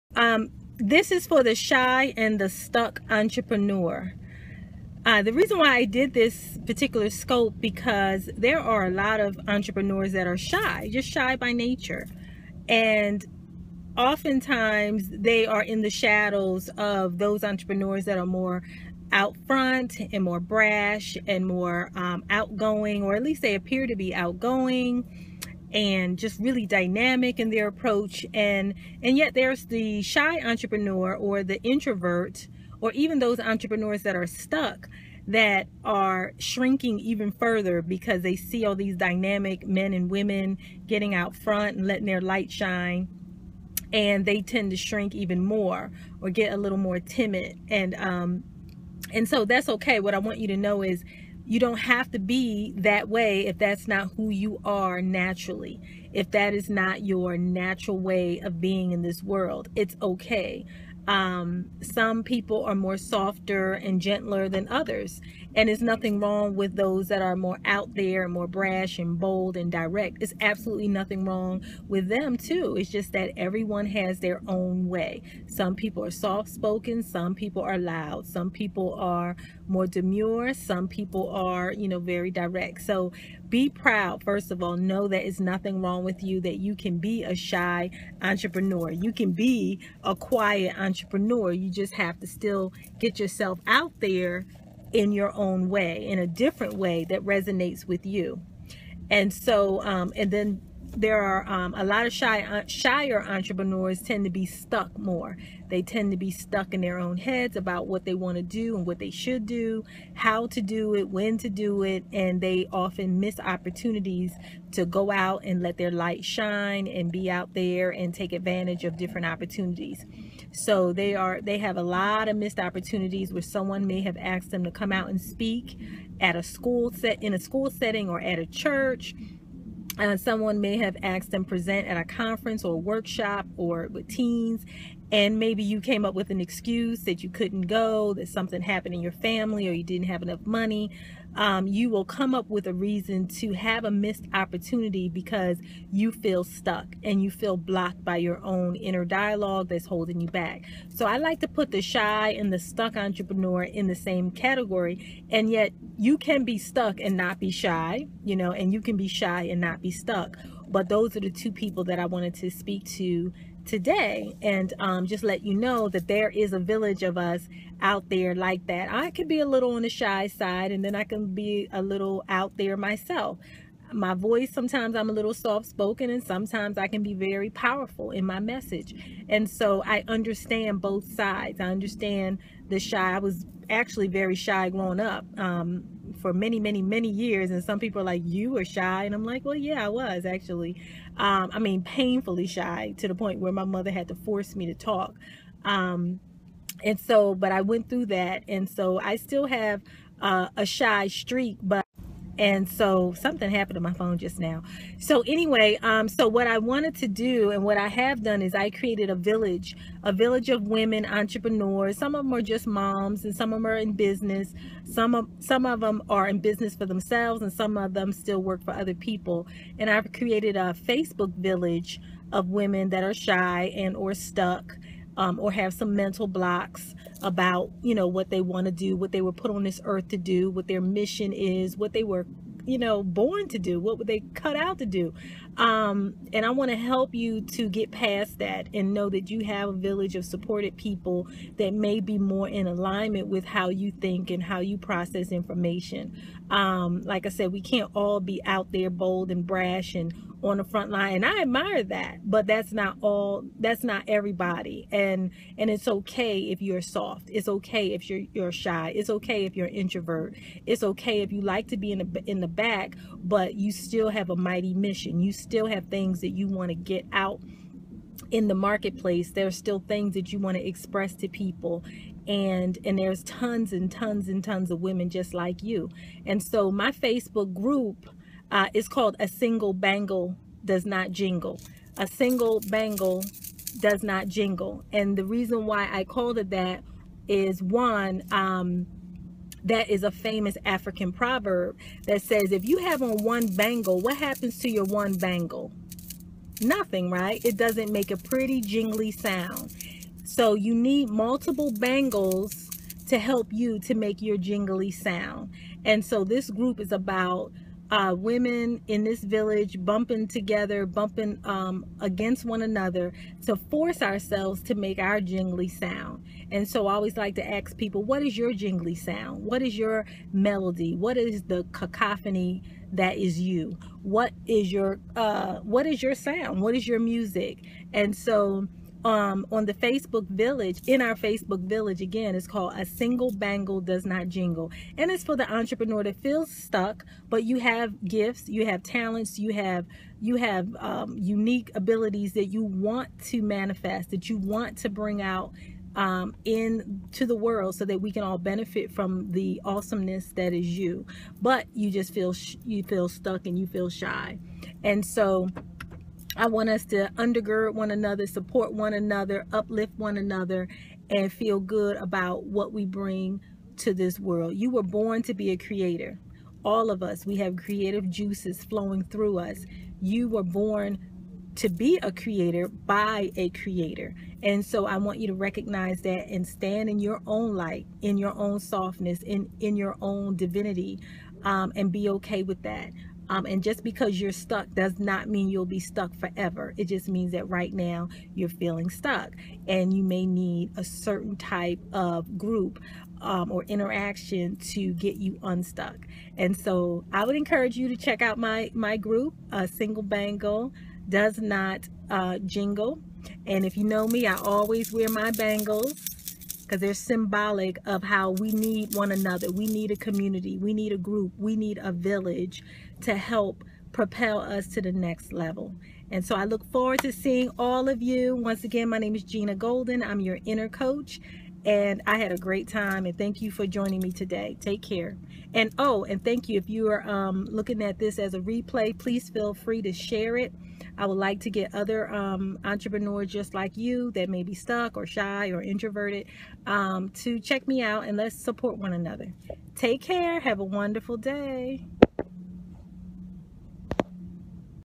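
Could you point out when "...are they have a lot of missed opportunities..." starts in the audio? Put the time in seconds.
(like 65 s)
121 s.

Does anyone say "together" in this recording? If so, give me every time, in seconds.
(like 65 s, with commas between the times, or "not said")
310 s.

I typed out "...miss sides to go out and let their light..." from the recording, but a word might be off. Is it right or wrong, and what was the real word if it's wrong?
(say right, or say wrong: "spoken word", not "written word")
wrong: "opportunities", not "sides".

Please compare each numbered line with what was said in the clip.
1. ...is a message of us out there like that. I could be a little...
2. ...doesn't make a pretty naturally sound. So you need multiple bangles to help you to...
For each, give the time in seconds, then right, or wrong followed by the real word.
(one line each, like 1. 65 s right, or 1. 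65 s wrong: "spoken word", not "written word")
1. 166 s wrong: "village", not "message"
2. 297 s wrong: "jingly", not "naturally".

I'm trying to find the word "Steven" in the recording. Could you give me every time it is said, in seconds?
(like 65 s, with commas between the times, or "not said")
not said.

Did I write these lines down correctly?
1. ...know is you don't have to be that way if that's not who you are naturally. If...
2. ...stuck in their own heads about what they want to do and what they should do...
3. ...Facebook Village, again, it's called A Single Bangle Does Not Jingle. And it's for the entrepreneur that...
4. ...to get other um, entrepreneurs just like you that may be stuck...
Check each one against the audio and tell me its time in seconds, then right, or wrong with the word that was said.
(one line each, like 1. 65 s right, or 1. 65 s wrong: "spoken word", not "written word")
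1. 50 s right
2. 106 s right
3. 331 s right
4. 431 s right.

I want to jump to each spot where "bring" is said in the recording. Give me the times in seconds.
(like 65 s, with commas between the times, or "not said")
344 s, 362 s.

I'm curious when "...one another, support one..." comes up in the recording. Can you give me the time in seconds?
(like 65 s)
357 s.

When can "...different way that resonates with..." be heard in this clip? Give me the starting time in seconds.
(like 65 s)
96 s.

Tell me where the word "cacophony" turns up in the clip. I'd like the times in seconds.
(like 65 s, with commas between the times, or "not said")
321 s.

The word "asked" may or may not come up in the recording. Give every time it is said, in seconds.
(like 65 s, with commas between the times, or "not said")
124 s, 131 s.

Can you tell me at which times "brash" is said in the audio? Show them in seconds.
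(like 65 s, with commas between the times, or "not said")
20 s, 68 s, 249 s.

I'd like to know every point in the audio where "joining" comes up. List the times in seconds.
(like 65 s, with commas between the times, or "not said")
423 s.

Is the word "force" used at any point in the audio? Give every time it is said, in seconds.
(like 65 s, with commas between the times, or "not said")
194 s, 313 s.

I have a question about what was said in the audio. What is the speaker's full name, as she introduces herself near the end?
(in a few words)
Gina Golden.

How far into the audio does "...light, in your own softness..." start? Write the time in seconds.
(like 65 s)
377 s.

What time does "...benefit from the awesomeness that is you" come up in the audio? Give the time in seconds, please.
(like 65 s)
348 s.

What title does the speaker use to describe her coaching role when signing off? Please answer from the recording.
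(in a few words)
inner coach.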